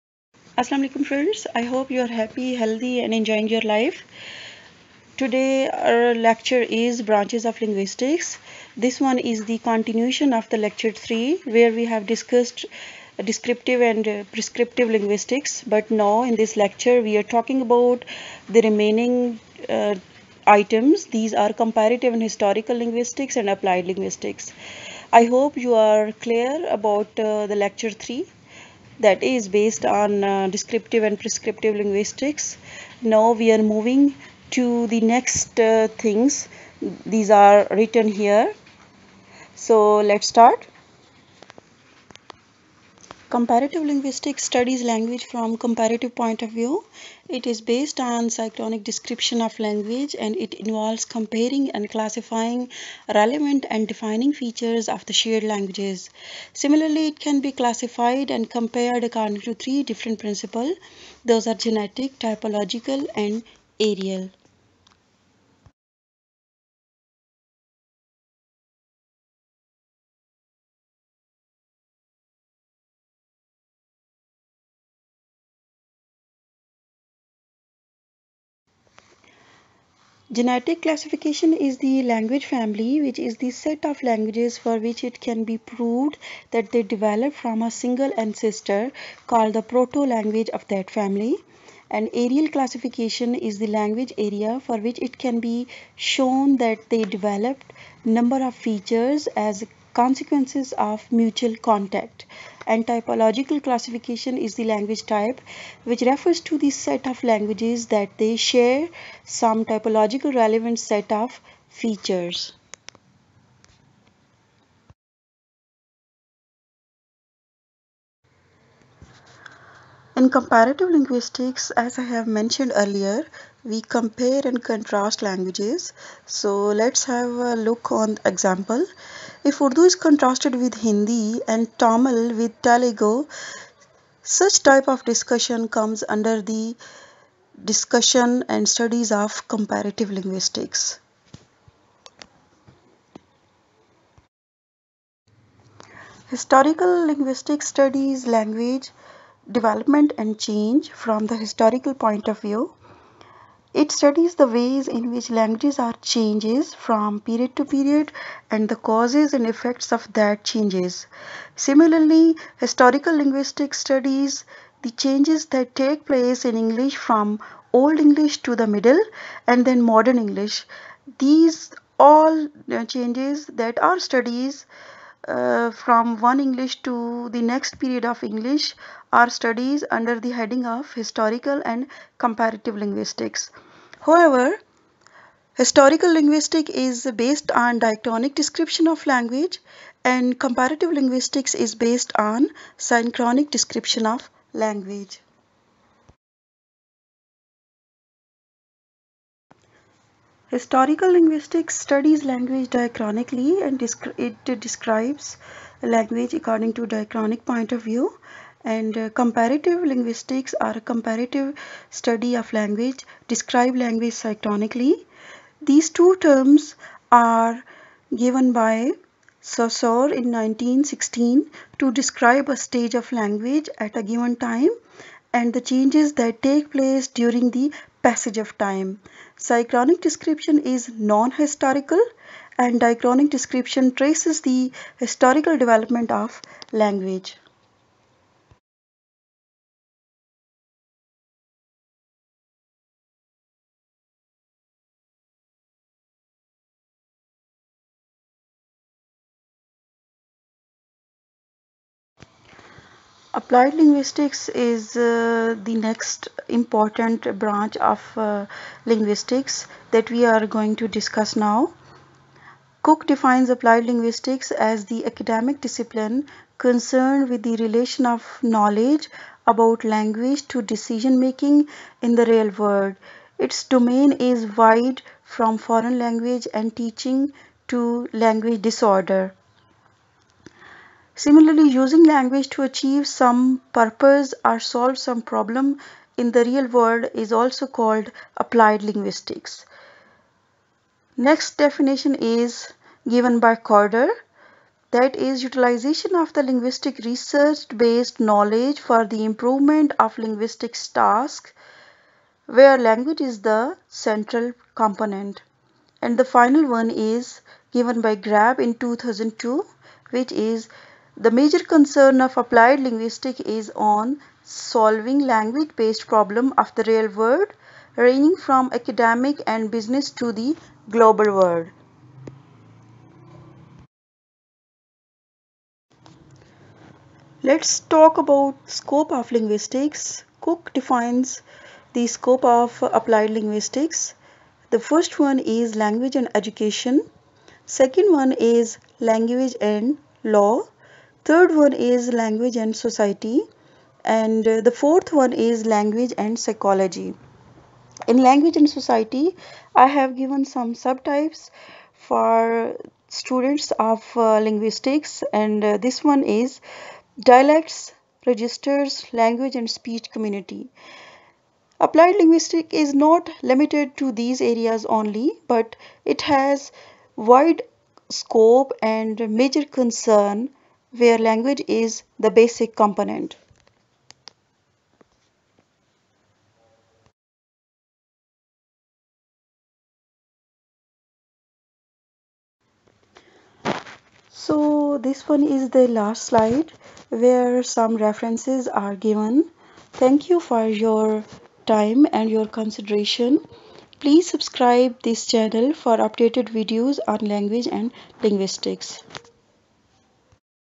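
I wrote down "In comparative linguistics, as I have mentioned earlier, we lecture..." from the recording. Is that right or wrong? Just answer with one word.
wrong.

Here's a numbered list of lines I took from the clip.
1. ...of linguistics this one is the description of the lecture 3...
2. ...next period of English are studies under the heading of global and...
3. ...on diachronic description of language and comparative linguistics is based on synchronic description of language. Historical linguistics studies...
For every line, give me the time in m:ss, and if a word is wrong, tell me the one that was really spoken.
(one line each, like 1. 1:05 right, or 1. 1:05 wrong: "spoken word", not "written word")
1. 0:07 wrong: "continuation", not "description"
2. 2:57 wrong: "historical", not "global"
3. 3:07 right.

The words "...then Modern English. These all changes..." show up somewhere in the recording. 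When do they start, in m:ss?
2:49.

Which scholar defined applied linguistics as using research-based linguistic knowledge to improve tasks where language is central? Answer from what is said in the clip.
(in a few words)
Corder.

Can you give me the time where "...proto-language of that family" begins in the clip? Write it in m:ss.
1:29.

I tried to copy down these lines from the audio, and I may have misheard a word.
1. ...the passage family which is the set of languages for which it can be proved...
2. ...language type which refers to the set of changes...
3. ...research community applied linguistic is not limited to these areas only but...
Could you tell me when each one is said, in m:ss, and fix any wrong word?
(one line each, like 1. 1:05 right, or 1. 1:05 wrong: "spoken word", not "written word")
1. 1:21 wrong: "language", not "passage"
2. 1:44 wrong: "languages", not "changes"
3. 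5:59 wrong: "speech", not "research".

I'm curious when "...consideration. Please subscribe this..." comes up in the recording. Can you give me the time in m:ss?
6:32.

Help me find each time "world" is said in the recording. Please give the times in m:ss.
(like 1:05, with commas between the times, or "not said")
4:32, 4:46, 5:17, 5:21.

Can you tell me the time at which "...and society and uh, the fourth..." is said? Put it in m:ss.
5:42.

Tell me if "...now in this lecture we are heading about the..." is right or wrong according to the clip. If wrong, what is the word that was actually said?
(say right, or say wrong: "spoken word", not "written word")
wrong: "talking", not "heading".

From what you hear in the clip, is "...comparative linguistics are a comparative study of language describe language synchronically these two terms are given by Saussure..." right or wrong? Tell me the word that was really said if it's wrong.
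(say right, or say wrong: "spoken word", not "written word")
right.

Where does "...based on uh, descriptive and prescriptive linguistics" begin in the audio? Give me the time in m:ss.
0:29.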